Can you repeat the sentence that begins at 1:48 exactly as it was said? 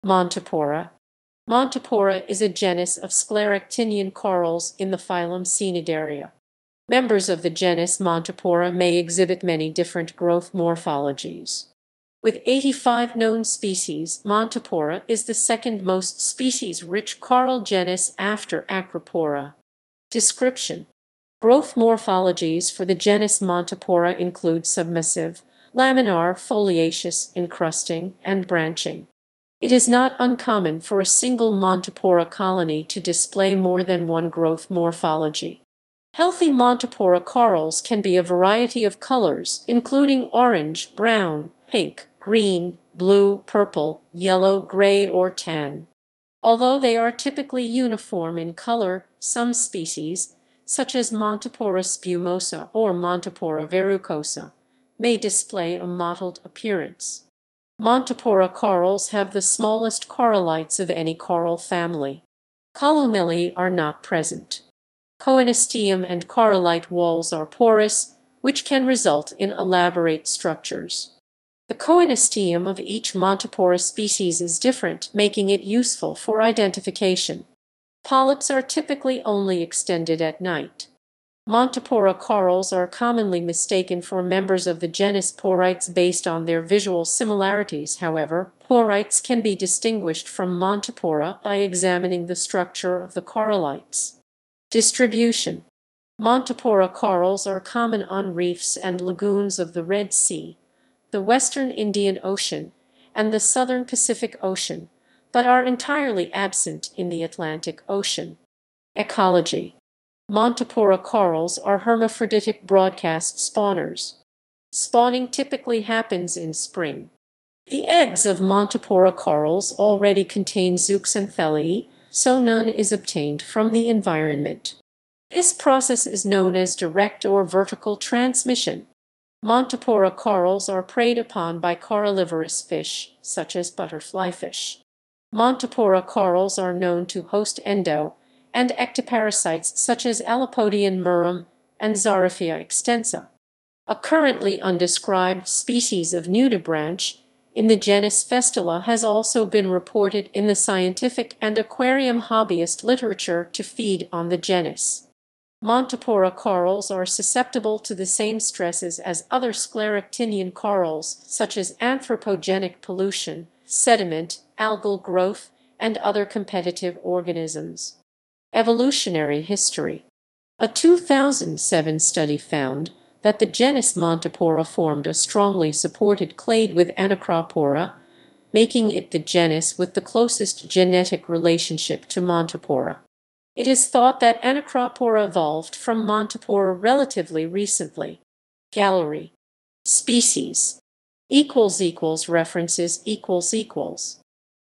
Ecology Montipora corals are hermaphroditic broadcast spawners.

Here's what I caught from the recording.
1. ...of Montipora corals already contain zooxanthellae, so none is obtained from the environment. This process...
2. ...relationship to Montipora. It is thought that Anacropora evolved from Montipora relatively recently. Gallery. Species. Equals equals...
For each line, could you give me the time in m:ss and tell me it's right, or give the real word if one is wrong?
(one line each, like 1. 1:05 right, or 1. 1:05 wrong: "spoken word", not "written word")
1. 1:58 right
2. 3:01 right.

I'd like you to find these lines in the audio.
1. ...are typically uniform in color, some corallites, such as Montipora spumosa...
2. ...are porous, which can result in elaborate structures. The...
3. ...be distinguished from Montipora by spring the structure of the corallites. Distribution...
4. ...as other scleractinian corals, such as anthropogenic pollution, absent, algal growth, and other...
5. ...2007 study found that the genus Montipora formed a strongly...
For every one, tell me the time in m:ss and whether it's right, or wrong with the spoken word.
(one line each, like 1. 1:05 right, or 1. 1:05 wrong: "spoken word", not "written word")
1. 0:46 wrong: "species", not "corallites"
2. 1:07 right
3. 1:29 wrong: "examining", not "spring"
4. 2:38 wrong: "sediment", not "absent"
5. 2:50 right.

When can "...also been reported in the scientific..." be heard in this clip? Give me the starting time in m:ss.
2:29.